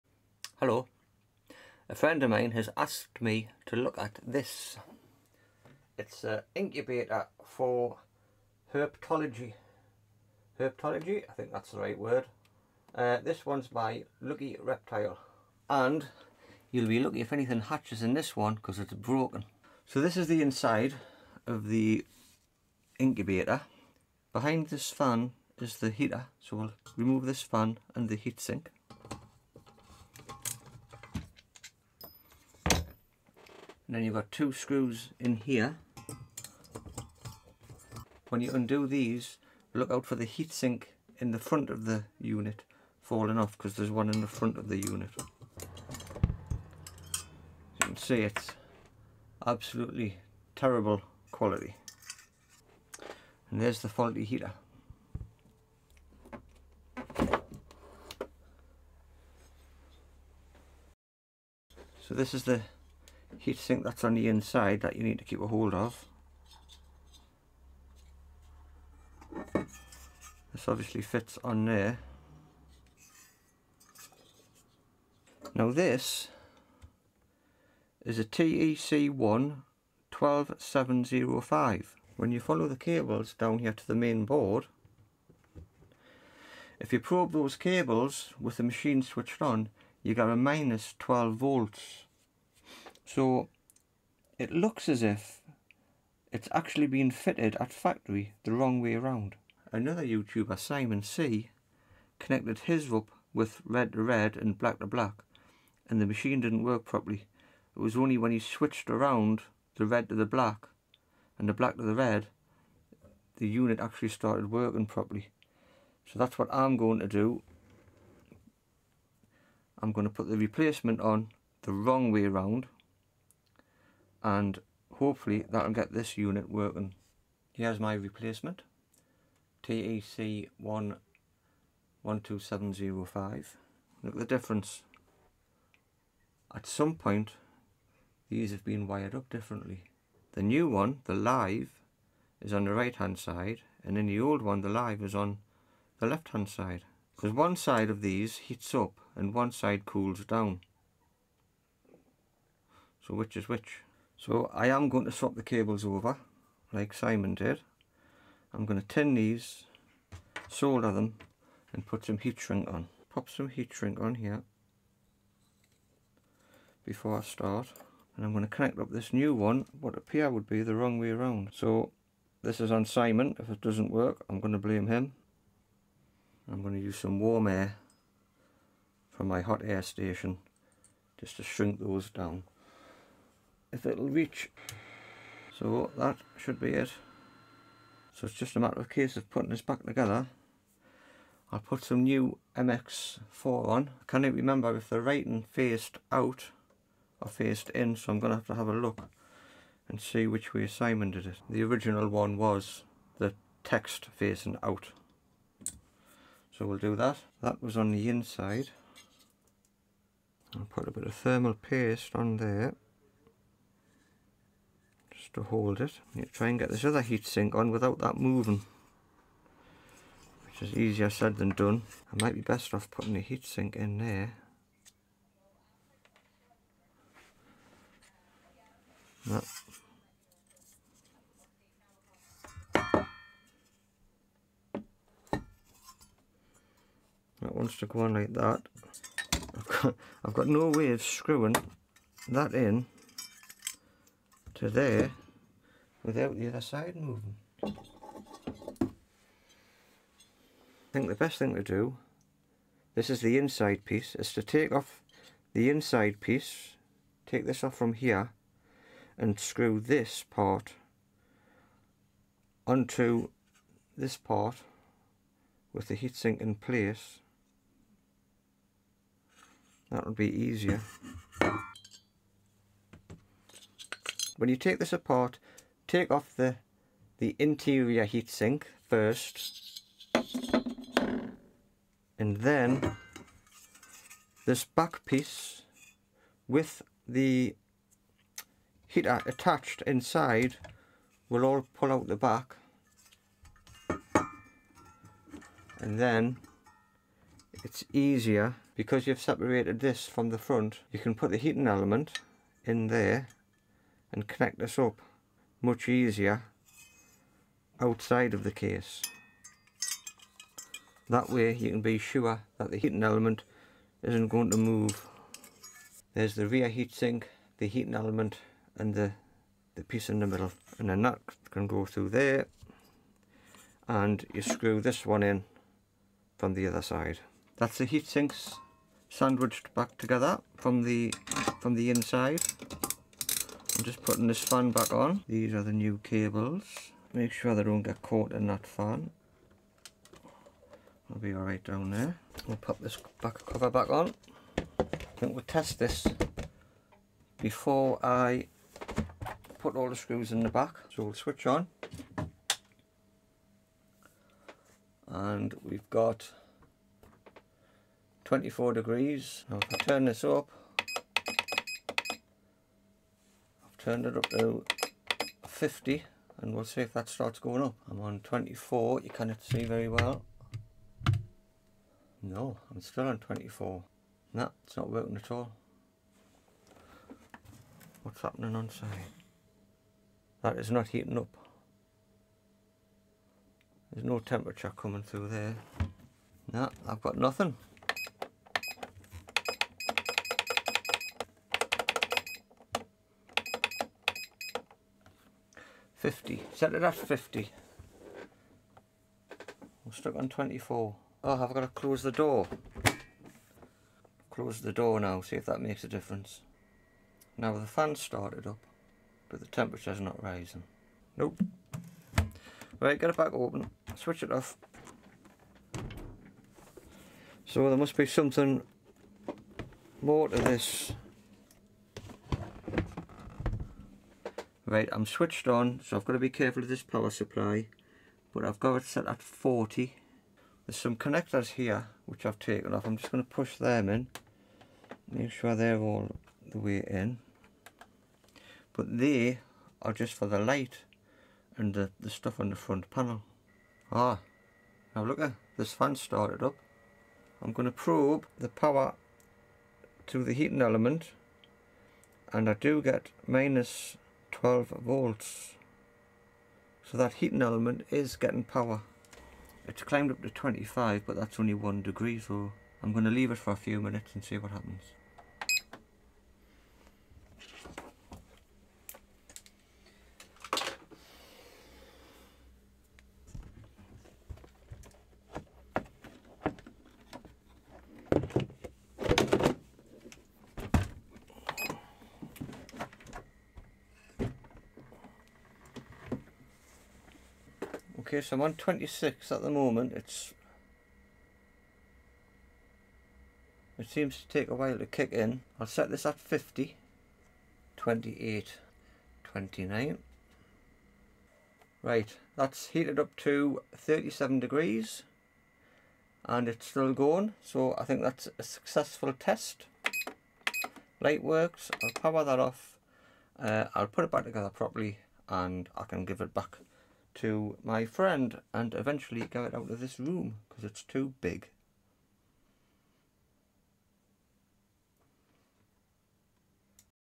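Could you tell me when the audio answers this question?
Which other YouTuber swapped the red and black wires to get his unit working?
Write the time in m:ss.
1:40.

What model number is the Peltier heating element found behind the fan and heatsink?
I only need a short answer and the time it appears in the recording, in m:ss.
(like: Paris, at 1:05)
TEC1 12705, at 1:18.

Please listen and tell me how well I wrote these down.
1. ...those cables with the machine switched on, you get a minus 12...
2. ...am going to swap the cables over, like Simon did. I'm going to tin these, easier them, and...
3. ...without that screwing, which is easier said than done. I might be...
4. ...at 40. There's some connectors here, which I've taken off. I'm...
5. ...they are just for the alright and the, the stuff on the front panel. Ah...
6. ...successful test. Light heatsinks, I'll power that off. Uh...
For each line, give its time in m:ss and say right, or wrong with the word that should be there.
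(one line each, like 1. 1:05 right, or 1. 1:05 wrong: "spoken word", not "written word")
1. 1:27 right
2. 2:34 wrong: "solder", not "easier"
3. 3:37 wrong: "moving", not "screwing"
4. 7:09 right
5. 7:18 wrong: "light", not "alright"
6. 8:28 wrong: "works", not "heatsinks".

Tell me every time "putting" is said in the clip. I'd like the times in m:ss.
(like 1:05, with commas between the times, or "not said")
3:09, 3:42, 5:34.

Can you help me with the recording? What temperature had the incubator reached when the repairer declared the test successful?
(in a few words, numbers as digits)
37 degrees.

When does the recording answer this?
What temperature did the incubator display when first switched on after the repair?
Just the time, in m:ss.
5:58.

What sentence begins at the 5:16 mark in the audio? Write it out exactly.
There's the rear heatsink, the heating element and the, the piece in the middle.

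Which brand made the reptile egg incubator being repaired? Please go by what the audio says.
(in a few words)
Lucky Reptile.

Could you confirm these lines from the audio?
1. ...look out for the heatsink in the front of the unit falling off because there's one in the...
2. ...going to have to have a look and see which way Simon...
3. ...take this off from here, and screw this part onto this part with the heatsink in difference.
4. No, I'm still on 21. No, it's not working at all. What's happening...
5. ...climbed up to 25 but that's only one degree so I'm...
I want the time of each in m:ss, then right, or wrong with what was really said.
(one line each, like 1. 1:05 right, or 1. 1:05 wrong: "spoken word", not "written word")
1. 0:39 right
2. 3:18 right
3. 4:17 wrong: "place", not "difference"
4. 6:12 wrong: "24", not "21"
5. 7:39 right.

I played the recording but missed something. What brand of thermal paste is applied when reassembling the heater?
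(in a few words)
MX4.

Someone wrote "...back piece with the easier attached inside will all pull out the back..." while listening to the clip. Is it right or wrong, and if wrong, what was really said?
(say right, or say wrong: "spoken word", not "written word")
wrong: "heater", not "easier".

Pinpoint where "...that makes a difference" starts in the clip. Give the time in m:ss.
6:45.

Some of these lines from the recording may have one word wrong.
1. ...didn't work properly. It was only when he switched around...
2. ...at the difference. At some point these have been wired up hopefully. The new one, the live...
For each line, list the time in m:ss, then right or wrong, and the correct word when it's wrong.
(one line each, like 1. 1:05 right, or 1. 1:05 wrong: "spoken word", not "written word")
1. 1:46 right
2. 2:14 wrong: "differently", not "hopefully".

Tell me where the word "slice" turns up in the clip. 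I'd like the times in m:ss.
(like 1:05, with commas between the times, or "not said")
not said.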